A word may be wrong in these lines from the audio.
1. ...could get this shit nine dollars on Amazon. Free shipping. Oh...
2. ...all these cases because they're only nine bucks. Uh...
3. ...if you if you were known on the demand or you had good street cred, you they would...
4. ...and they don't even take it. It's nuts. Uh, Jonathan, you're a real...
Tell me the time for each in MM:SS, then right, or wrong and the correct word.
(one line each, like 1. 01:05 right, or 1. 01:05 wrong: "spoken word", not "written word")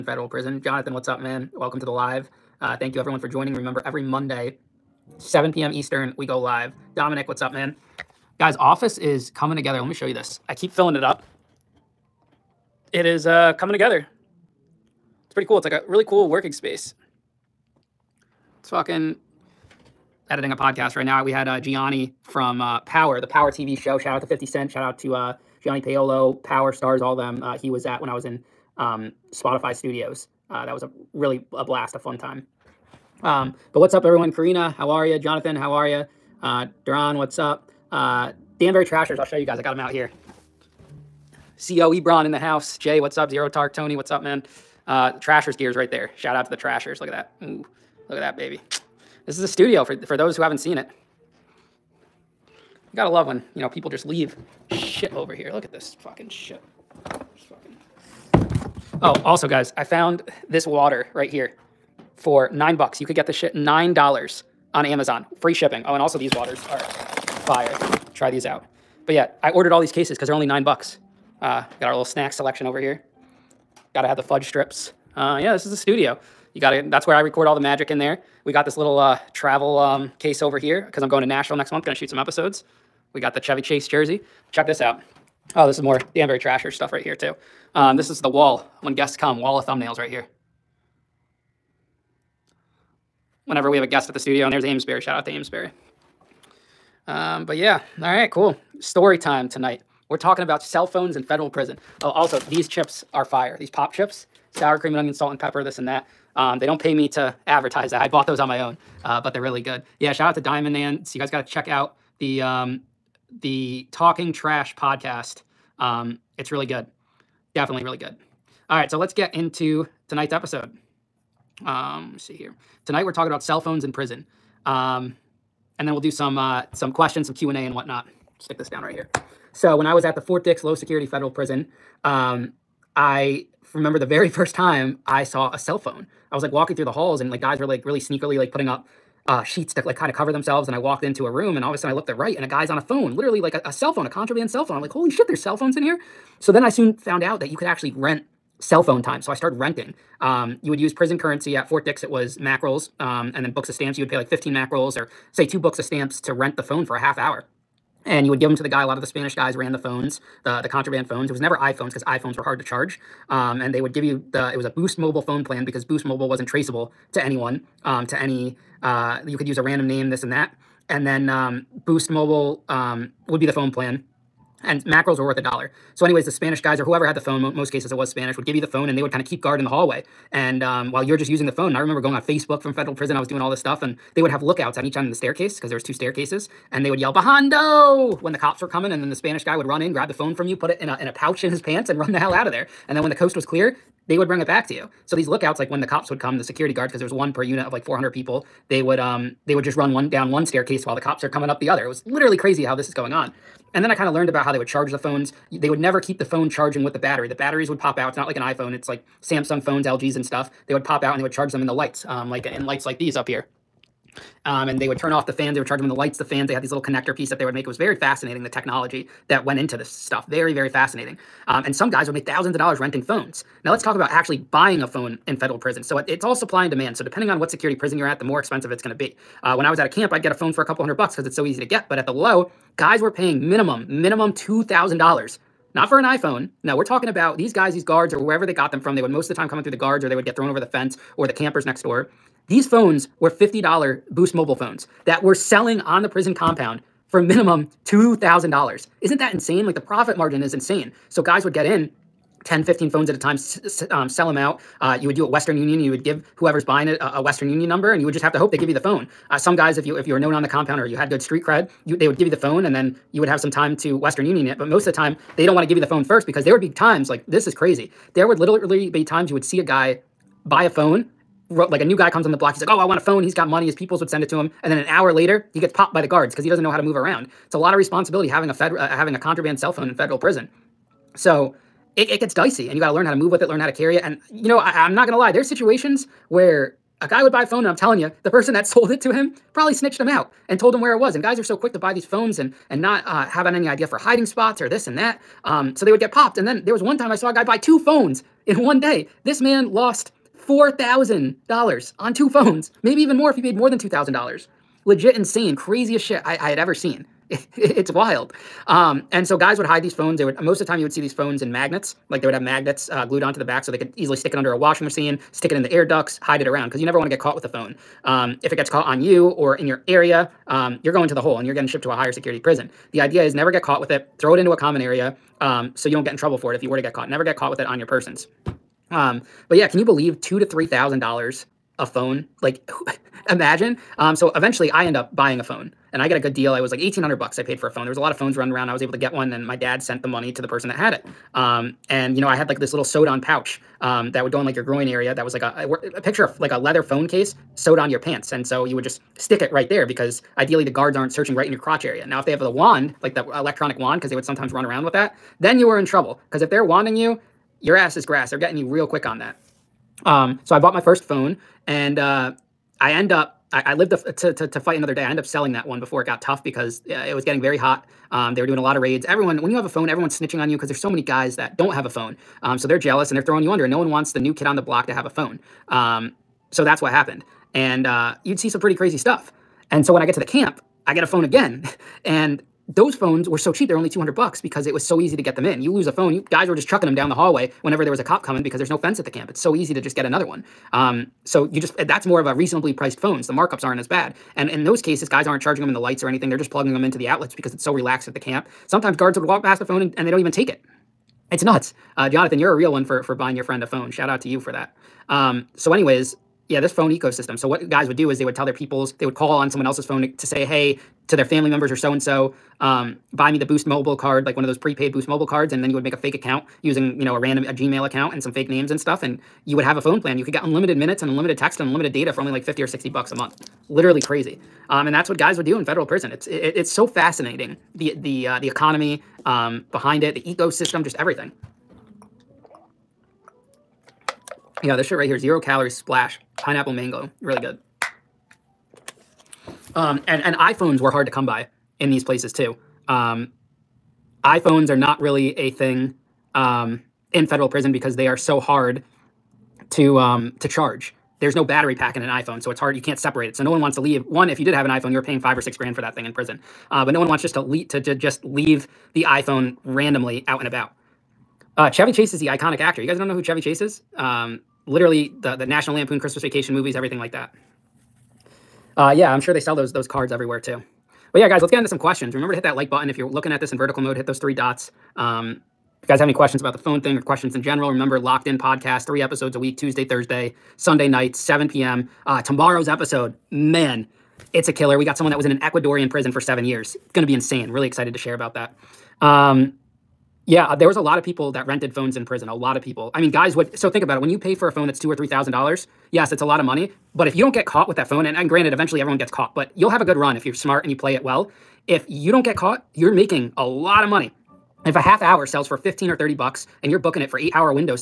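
1. 01:03 right
2. 01:09 right
3. 04:19 wrong: "compound", not "demand"
4. 06:39 right.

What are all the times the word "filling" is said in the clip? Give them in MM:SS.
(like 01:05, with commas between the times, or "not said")
00:10.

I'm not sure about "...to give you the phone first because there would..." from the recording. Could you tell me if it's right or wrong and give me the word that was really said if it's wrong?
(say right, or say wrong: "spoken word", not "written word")
right.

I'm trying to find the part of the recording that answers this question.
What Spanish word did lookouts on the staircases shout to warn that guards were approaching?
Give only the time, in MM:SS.
03:07.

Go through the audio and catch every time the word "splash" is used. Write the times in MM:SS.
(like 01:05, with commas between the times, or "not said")
07:15.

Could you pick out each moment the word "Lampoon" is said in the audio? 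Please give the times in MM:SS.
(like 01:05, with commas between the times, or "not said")
07:45.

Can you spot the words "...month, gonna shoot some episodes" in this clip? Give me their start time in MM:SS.
01:21.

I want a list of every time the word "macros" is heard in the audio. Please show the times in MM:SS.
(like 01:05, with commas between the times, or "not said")
02:54.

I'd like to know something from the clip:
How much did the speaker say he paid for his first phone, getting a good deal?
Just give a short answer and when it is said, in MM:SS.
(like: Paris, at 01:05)
1800 dollars, at 05:36.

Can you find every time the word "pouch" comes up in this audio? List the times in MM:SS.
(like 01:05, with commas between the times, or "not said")
03:11, 05:43.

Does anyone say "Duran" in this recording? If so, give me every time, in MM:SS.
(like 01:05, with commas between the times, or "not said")
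00:36.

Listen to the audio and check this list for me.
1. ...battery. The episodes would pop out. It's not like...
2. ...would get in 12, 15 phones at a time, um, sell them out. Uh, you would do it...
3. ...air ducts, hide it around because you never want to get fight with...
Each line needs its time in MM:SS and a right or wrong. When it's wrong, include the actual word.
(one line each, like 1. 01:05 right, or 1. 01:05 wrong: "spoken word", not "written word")
1. 03:26 wrong: "batteries", not "episodes"
2. 04:11 wrong: "10", not "12"
3. 05:15 wrong: "caught", not "fight".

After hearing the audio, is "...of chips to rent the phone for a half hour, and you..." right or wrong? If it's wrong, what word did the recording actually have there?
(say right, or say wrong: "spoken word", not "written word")
wrong: "stamps", not "chips".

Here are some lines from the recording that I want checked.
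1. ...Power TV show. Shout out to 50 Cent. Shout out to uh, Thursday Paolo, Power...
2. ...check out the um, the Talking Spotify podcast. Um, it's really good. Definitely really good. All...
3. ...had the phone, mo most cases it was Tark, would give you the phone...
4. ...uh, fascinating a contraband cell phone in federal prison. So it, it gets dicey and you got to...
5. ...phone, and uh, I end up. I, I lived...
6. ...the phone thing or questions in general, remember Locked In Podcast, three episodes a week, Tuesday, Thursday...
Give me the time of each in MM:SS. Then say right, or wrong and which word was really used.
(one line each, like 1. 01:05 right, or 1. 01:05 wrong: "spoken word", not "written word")
1. 00:23 wrong: "Gianni", not "Thursday"
2. 01:51 wrong: "Trash", not "Spotify"
3. 02:57 wrong: "Spanish", not "Tark"
4. 04:38 wrong: "having", not "fascinating"
5. 06:01 right
6. 07:56 right.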